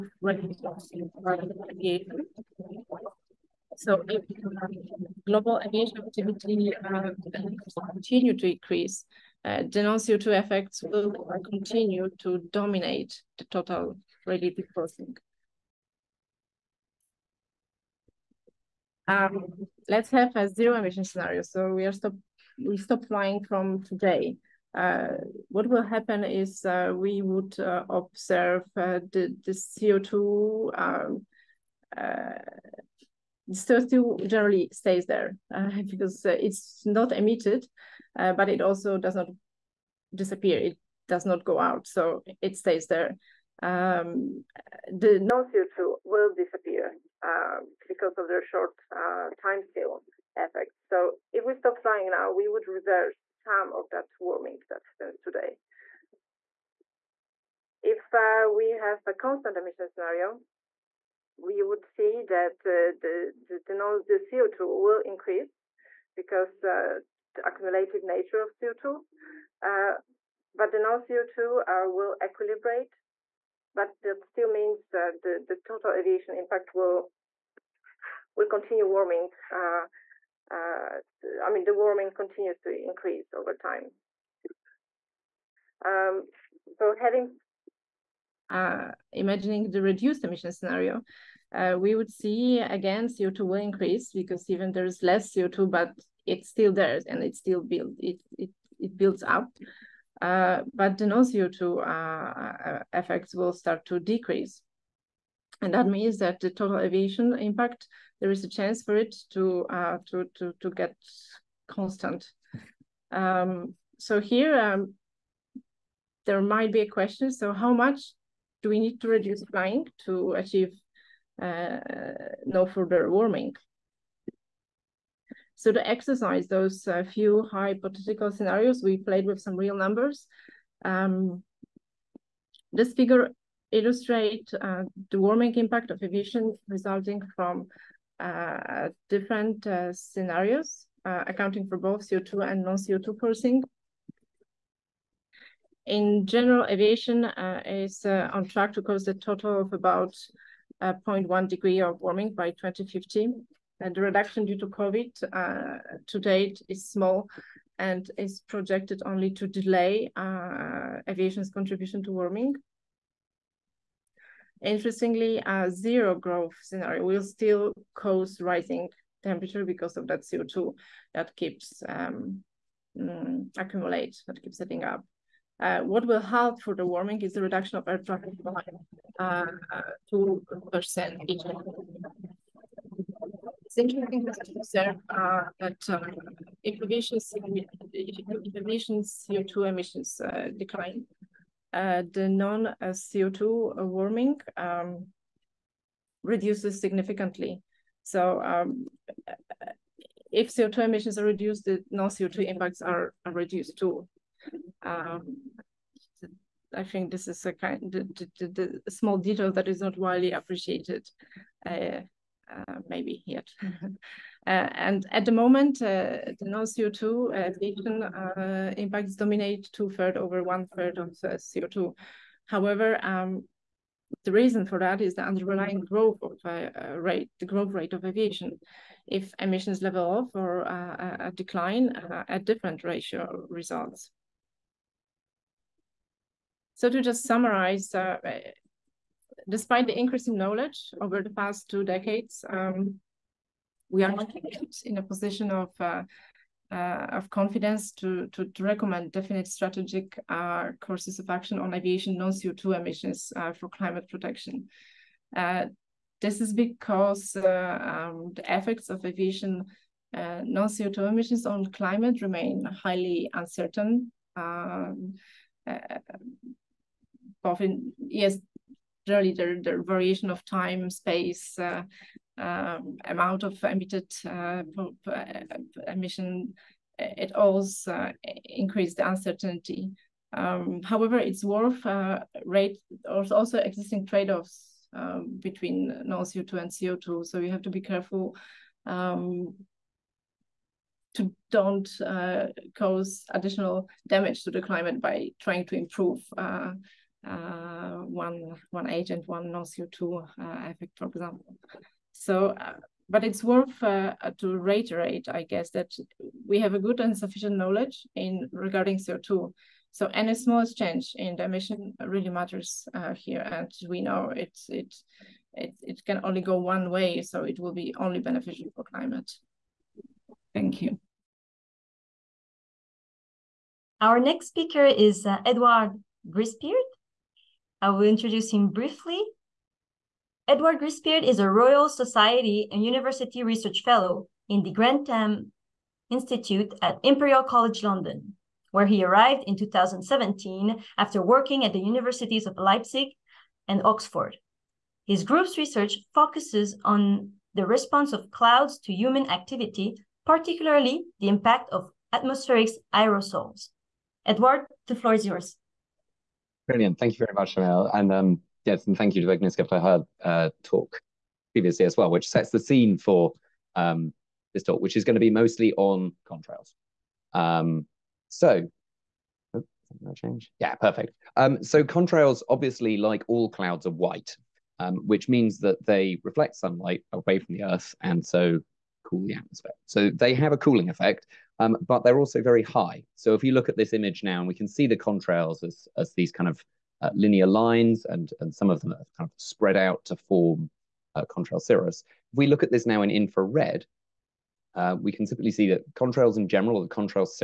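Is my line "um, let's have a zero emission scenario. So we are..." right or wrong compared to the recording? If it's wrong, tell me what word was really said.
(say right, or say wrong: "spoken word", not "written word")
right.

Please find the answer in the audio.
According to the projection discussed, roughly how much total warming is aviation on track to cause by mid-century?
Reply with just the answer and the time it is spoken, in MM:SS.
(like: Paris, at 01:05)
0.1 degree, at 02:30.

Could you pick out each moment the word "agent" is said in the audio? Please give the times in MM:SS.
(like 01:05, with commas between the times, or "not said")
04:58.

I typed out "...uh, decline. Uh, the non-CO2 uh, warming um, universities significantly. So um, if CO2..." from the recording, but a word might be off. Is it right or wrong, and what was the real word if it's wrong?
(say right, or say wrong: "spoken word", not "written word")
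wrong: "reduces", not "universities".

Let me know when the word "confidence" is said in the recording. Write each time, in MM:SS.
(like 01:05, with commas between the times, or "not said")
04:07.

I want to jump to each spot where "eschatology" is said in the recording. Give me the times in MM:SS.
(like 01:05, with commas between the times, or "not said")
not said.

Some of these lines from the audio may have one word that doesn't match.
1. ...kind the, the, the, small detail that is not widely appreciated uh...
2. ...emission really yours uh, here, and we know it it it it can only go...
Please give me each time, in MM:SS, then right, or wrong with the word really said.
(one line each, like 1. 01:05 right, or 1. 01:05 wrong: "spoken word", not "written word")
1. 03:27 right
2. 05:11 wrong: "matters", not "yours".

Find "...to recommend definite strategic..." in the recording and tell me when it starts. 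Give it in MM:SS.
04:08.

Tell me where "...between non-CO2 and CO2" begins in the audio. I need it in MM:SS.
04:45.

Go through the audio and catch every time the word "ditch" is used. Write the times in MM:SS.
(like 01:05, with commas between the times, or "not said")
not said.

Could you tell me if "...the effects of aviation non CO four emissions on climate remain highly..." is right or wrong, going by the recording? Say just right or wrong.
wrong.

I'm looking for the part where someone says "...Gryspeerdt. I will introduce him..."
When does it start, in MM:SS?
05:26.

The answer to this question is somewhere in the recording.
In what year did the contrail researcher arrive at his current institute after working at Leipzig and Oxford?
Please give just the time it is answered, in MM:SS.
05:39.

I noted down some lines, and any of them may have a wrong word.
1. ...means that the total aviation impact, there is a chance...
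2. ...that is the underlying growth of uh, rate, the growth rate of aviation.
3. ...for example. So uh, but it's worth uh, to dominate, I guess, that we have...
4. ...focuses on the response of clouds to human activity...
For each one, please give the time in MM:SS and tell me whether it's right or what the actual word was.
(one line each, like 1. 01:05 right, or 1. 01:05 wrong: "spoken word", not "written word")
1. 01:45 right
2. 03:44 right
3. 05:00 wrong: "reiterate", not "dominate"
4. 05:46 right.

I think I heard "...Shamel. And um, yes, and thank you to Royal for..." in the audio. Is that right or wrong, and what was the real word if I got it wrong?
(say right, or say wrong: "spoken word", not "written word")
wrong: "Agnieszka", not "Royal".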